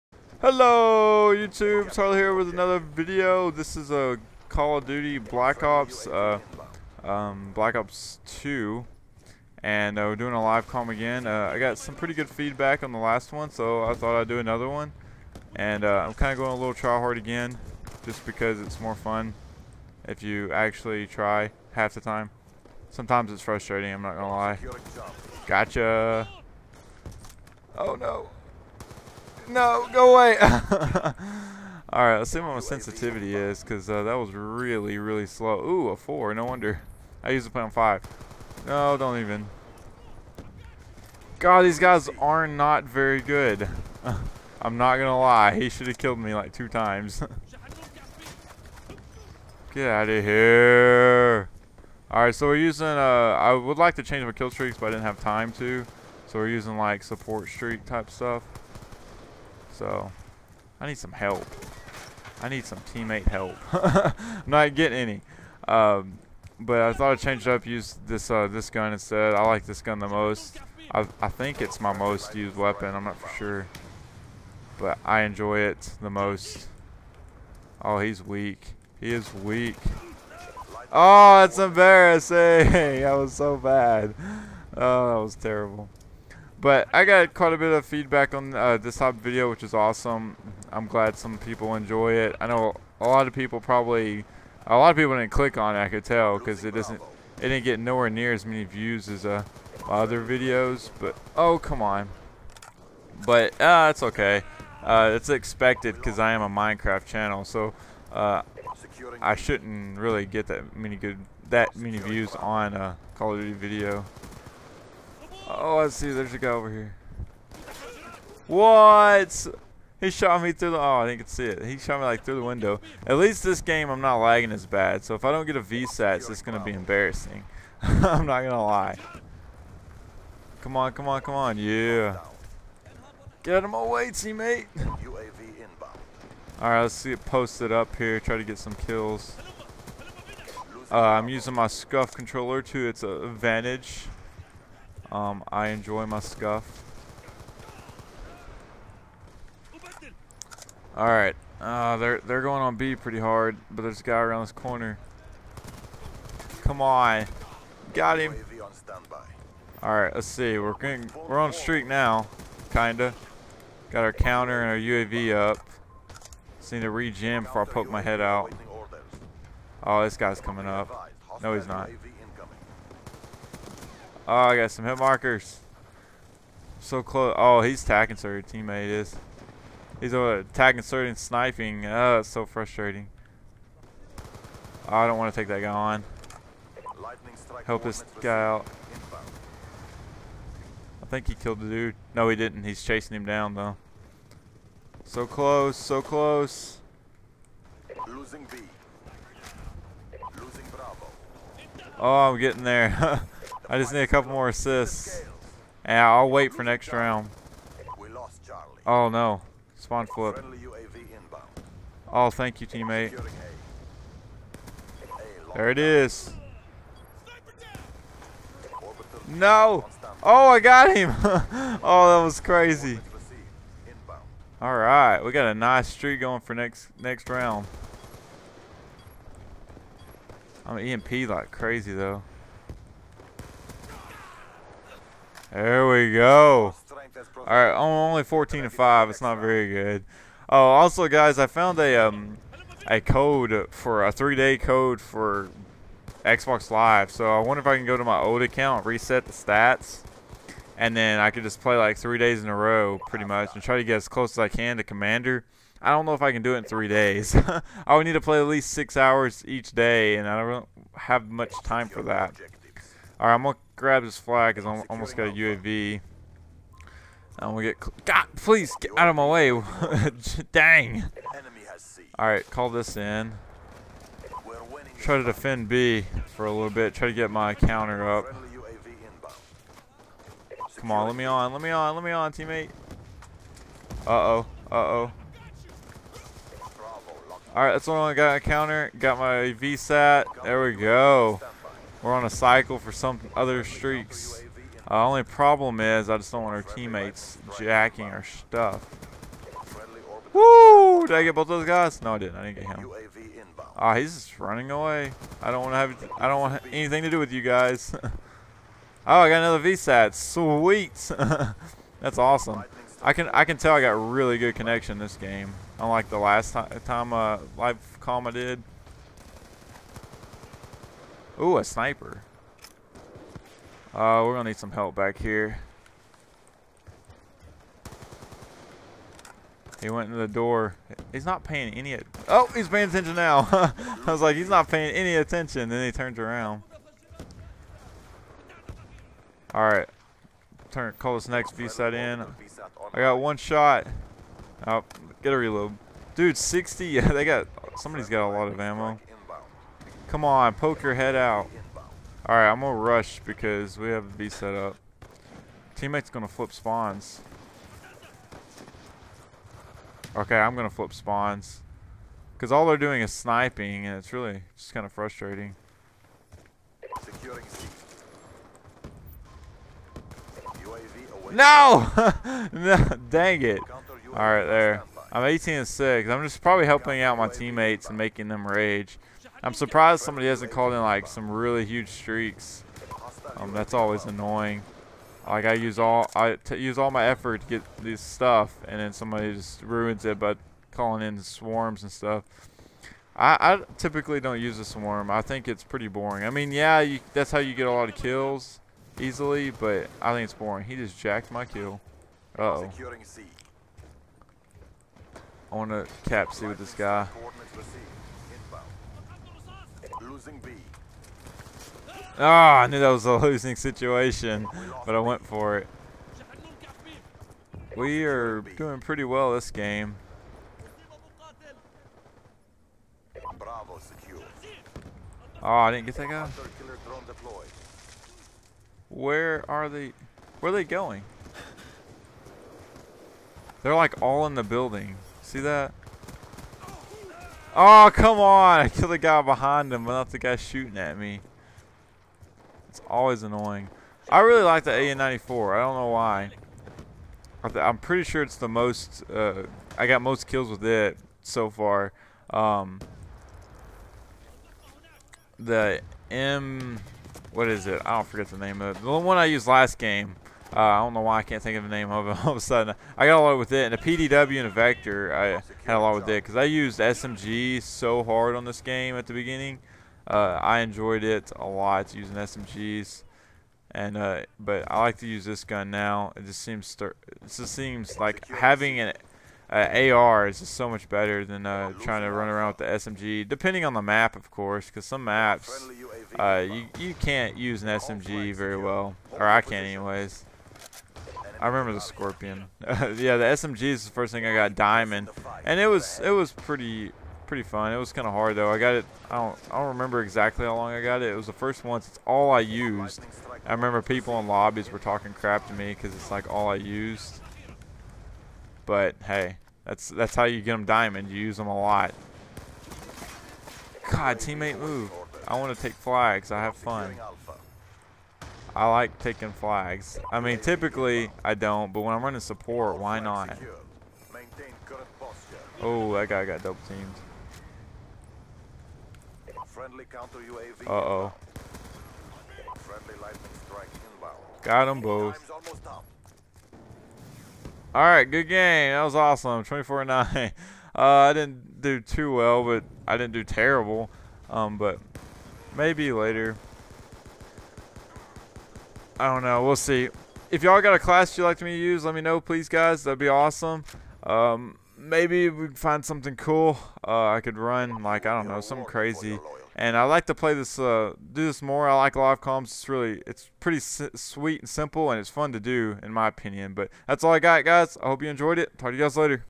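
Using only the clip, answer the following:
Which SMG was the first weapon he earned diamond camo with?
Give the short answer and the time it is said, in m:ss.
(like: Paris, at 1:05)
Scorpion, at 8:11.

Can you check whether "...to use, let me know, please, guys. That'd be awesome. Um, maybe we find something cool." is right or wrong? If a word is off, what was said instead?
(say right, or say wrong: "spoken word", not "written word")
right.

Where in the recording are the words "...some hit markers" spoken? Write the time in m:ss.
2:54.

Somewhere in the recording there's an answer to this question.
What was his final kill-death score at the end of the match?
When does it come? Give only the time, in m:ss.
8:59.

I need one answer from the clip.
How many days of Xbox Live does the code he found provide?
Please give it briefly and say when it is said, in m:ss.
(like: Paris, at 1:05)
3, at 4:04.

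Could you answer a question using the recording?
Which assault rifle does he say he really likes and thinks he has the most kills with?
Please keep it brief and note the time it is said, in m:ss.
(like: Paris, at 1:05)
AN94, at 7:24.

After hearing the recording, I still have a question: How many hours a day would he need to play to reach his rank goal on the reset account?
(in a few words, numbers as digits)
6.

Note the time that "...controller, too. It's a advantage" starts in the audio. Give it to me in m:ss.
2:22.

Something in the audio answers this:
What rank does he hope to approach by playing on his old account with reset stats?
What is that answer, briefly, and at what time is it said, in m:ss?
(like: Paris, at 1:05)
Commander, at 4:13.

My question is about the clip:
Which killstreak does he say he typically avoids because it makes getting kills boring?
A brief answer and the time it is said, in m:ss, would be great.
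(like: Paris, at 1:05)
Swarm, at 6:33.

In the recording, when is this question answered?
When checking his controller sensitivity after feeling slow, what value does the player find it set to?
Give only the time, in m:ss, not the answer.
0:35.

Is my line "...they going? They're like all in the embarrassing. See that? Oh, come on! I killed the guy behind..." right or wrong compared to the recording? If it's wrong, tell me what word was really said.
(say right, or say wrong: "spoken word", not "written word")
wrong: "building", not "embarrassing".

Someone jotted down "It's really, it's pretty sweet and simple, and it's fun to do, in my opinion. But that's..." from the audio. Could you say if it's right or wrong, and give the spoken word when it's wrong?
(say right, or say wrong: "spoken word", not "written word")
right.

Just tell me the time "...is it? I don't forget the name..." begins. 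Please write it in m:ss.
7:37.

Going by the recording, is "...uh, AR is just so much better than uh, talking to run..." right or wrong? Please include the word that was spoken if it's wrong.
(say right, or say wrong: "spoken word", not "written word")
wrong: "trying", not "talking".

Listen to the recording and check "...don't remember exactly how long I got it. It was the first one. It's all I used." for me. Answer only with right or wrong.
right.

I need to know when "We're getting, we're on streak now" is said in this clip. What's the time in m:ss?
2:40.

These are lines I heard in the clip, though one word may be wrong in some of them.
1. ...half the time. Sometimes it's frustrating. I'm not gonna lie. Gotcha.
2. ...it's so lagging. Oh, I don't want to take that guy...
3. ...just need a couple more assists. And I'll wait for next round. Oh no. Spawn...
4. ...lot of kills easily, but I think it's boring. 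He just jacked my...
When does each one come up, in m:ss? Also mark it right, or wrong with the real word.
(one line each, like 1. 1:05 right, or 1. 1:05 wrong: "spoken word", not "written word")
1. 0:21 right
2. 3:02 wrong: "frustrating", not "lagging"
3. 3:23 right
4. 6:37 right.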